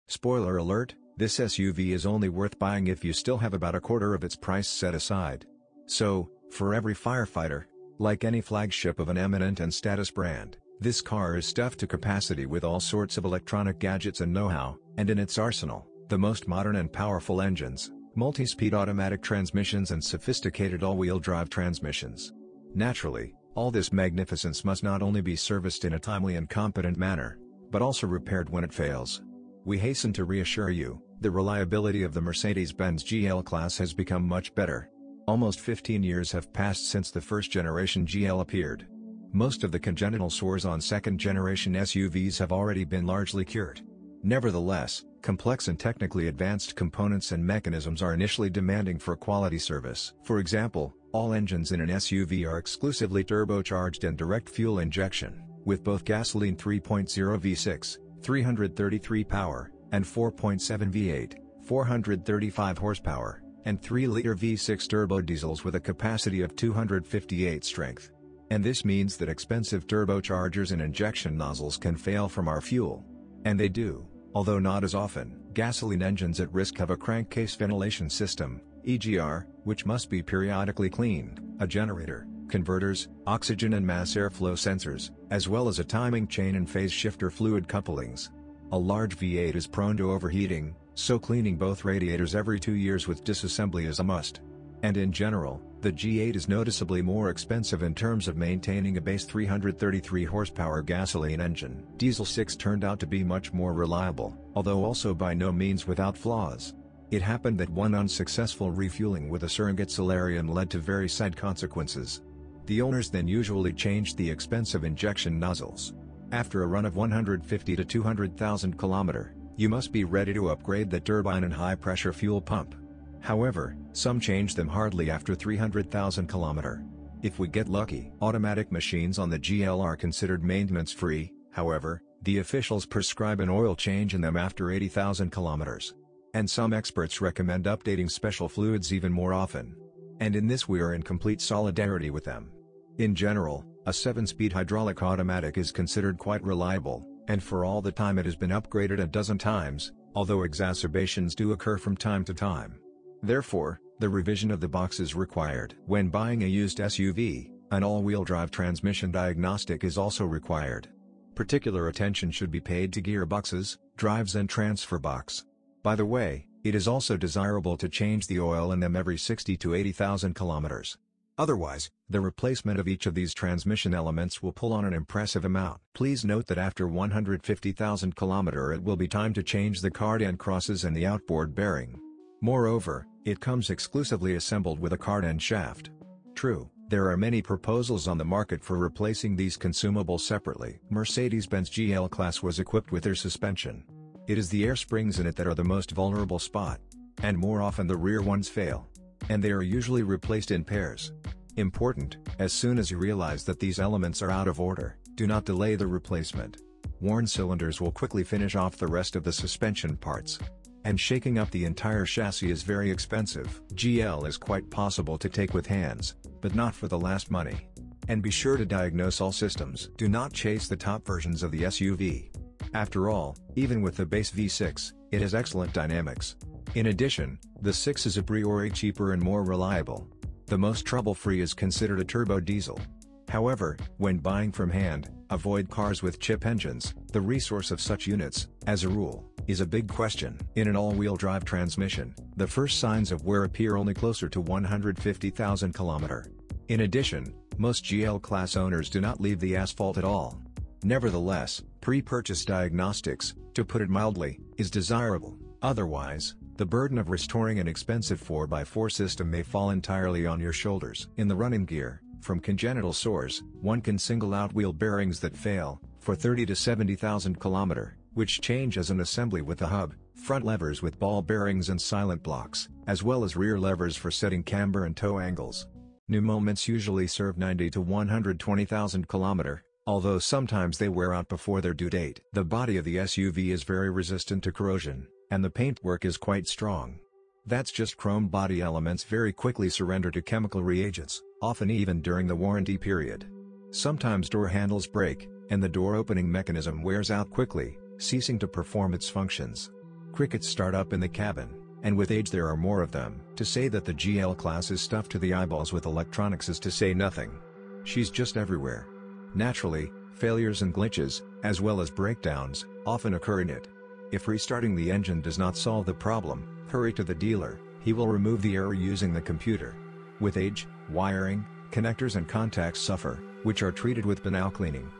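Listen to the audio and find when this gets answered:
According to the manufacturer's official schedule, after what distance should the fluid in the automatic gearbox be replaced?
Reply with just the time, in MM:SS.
02:14.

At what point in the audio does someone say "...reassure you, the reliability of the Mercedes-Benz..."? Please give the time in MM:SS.
00:30.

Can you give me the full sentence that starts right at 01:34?
And in general, the V8 is noticeably more expensive in terms of maintaining a base 333 horsepower gasoline engine.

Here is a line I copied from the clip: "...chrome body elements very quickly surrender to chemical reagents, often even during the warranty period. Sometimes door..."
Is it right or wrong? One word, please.
right.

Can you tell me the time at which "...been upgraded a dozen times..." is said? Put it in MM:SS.
02:28.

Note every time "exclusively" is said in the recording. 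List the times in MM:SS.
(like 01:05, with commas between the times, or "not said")
00:52, 03:03.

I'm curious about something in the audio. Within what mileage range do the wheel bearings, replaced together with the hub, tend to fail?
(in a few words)
30,000 to 70,000 km.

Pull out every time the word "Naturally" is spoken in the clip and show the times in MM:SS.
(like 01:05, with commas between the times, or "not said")
00:22, 05:09.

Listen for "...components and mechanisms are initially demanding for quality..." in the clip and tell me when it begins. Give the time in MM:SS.
00:46.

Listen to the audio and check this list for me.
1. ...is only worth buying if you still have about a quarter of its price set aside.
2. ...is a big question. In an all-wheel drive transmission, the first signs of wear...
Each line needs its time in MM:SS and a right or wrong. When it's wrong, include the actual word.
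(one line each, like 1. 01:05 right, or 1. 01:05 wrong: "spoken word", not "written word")
1. 00:01 right
2. 03:59 right.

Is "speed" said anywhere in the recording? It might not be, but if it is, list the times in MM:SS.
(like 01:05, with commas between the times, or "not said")
00:18, 02:23.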